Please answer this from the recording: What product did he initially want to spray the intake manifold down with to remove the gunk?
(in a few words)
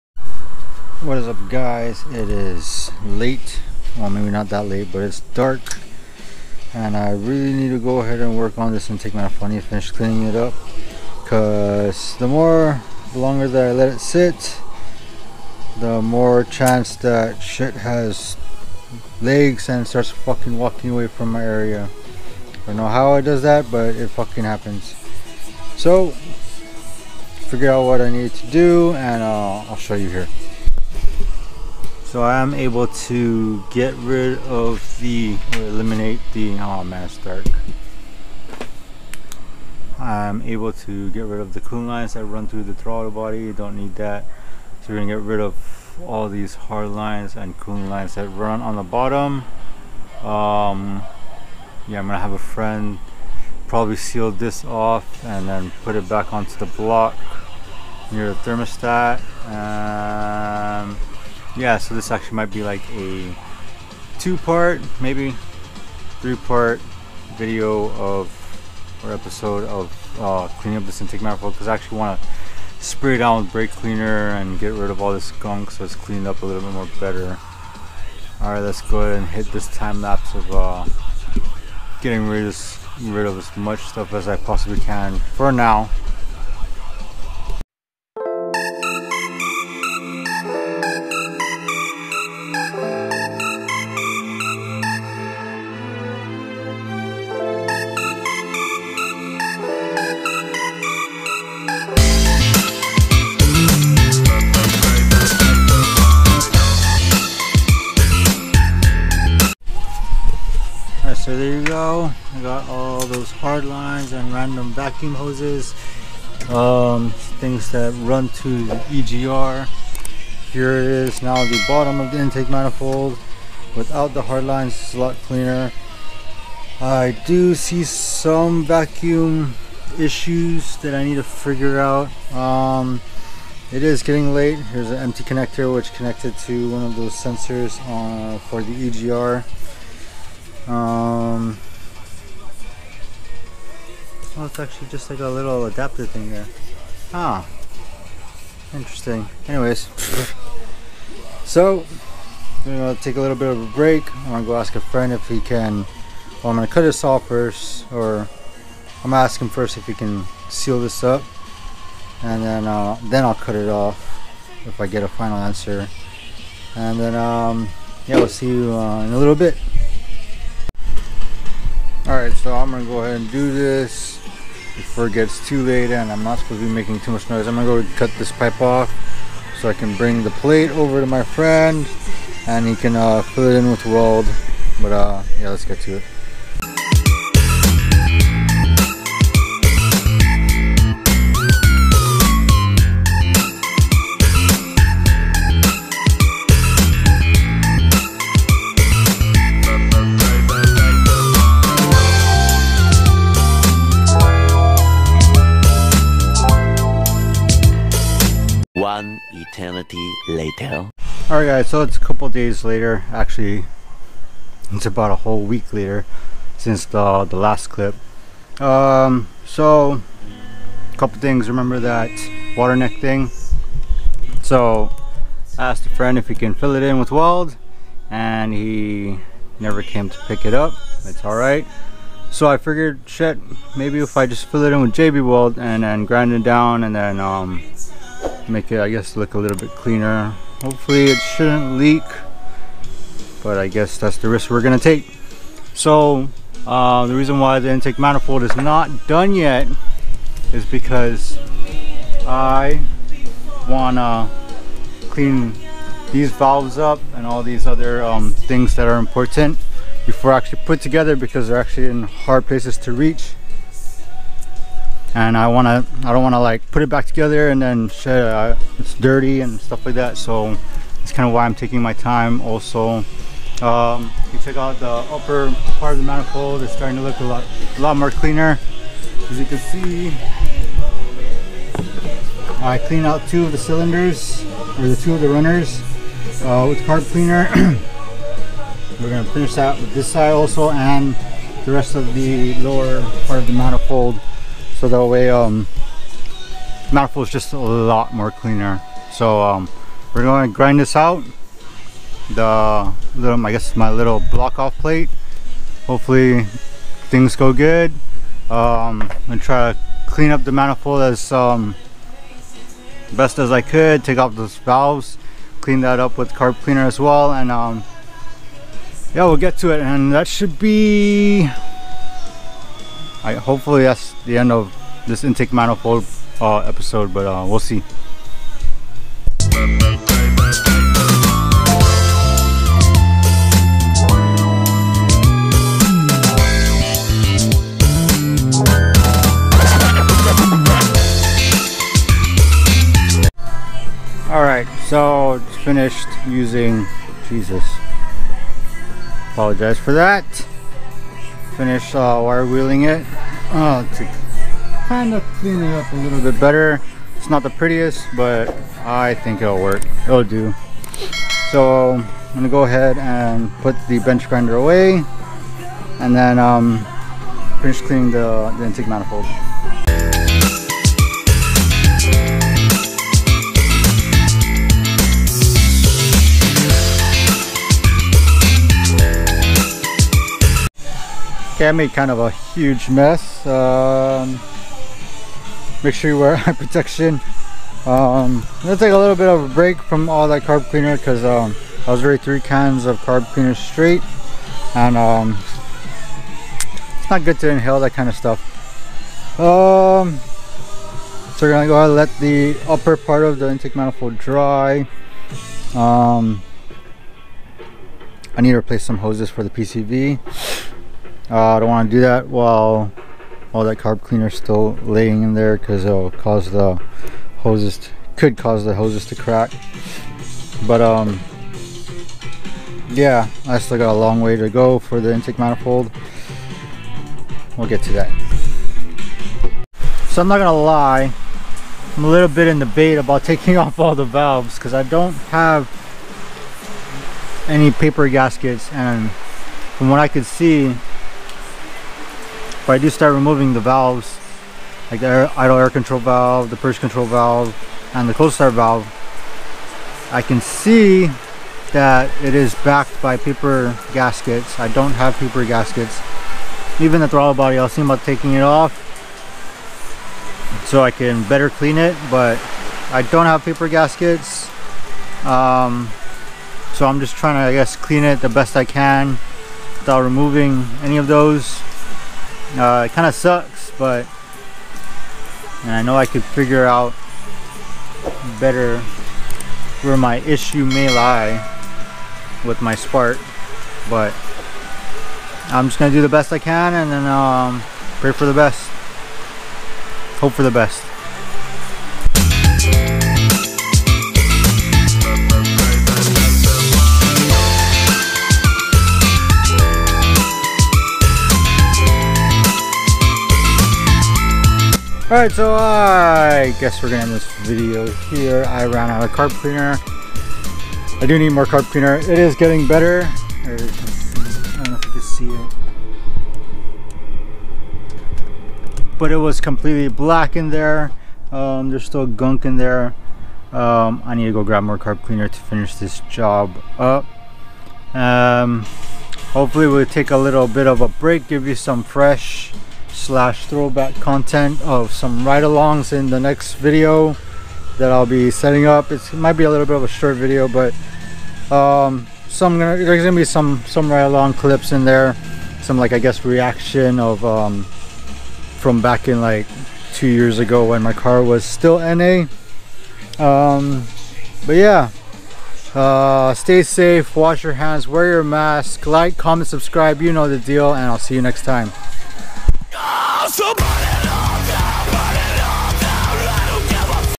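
brake cleaner.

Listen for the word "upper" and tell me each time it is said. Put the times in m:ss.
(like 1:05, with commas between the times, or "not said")
4:35, 6:42.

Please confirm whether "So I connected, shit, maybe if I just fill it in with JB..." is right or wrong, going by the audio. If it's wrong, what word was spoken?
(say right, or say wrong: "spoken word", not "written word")
wrong: "figured", not "connected".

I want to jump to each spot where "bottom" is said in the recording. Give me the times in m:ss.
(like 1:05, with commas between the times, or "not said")
0:48, 2:01.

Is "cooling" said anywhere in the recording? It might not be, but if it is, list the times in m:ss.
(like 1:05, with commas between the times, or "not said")
0:41, 0:47.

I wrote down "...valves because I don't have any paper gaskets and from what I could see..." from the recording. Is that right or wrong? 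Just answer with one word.
right.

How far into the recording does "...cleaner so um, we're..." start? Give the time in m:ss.
4:58.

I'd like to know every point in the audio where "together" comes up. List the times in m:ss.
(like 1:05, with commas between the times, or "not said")
4:20, 4:27.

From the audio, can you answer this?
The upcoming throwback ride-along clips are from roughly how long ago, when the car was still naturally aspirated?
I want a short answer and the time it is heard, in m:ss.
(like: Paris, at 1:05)
2 years ago, at 9:09.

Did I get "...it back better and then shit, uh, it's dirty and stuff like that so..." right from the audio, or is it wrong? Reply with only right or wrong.
wrong.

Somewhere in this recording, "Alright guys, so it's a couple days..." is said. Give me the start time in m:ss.
3:31.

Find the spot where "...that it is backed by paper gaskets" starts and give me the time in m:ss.
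7:31.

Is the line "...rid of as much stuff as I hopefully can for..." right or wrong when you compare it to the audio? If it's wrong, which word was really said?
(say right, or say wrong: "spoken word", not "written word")
wrong: "possibly", not "hopefully".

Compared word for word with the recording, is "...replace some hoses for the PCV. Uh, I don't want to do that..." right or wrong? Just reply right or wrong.
right.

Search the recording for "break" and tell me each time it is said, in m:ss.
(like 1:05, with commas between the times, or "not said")
2:33, 6:29, 8:50.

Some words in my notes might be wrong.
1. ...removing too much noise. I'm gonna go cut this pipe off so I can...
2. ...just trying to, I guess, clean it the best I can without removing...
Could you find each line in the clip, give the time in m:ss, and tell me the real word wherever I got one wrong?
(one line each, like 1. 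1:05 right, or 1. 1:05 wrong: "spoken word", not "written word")
1. 2:56 wrong: "making", not "removing"
2. 7:46 right.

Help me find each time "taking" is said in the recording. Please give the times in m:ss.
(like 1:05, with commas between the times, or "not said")
4:31, 7:13, 7:38.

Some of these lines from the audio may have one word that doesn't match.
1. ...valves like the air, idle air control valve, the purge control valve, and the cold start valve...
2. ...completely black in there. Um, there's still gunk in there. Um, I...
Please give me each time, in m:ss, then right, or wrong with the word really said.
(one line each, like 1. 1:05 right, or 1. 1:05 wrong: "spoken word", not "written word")
1. 7:23 right
2. 8:39 right.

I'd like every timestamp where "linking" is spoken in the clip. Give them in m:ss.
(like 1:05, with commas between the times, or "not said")
not said.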